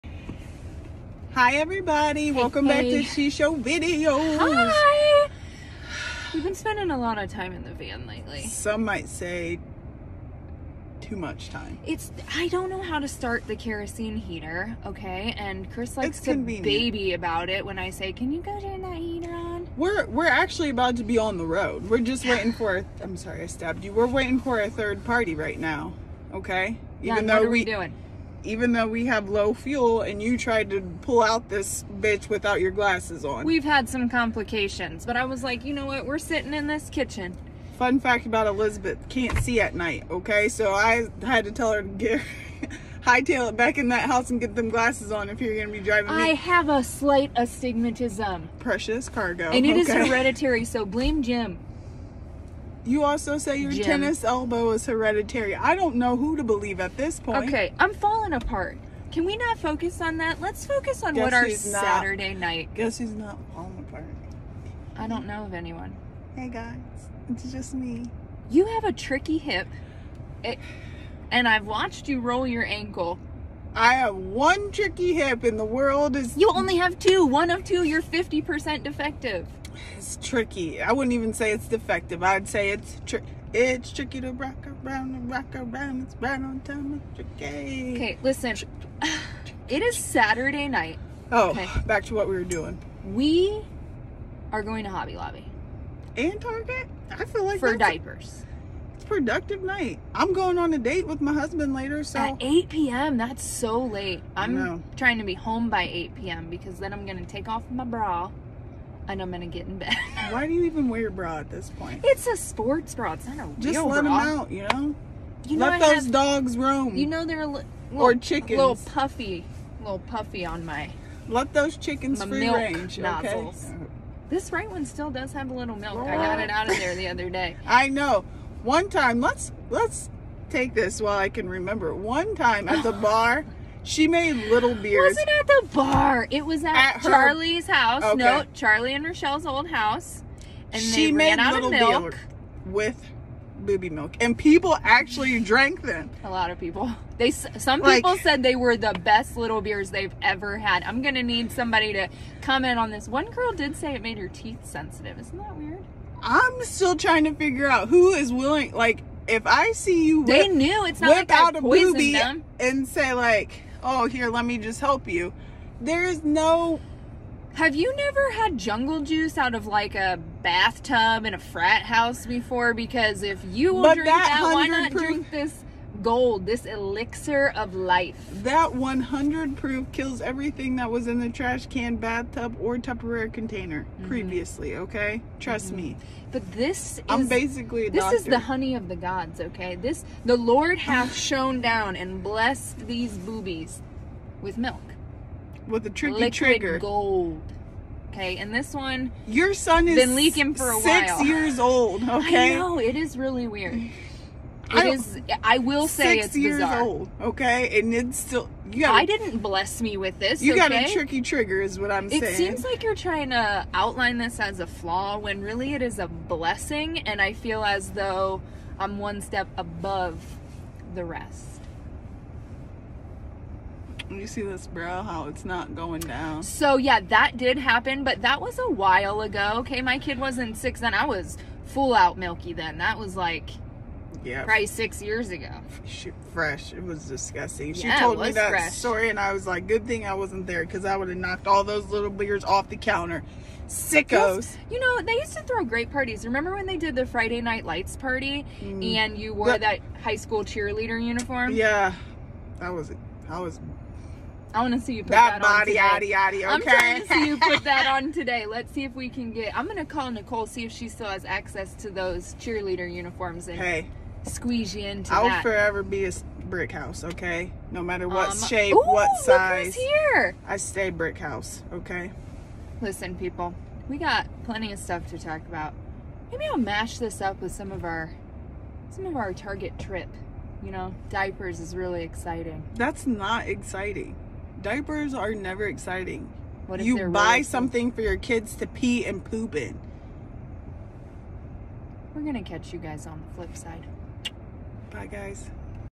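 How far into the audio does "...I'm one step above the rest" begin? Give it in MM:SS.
03:38.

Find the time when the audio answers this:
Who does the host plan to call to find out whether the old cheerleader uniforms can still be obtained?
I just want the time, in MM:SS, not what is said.
04:20.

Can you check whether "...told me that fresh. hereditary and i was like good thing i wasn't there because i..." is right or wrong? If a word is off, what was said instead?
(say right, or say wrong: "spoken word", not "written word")
wrong: "story", not "hereditary".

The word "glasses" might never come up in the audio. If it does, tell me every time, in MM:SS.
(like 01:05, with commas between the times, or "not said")
00:32, 00:44.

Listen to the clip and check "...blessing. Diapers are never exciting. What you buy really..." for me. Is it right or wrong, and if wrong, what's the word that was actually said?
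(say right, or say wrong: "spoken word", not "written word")
wrong: "exciting", not "blessing".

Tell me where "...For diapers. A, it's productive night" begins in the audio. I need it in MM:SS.
01:37.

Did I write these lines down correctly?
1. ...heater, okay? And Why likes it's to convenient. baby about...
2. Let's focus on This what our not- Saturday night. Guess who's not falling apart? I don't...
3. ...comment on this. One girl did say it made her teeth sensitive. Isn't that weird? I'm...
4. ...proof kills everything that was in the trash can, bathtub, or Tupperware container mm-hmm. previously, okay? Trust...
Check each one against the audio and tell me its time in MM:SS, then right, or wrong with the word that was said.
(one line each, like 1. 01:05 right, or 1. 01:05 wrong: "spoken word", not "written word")
1. 00:14 wrong: "Chris", not "Why"
2. 01:00 wrong: "Guess", not "This"
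3. 02:32 right
4. 02:59 right.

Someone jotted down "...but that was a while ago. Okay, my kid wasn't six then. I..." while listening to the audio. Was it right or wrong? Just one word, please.
right.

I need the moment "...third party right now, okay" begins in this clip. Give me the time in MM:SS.
00:24.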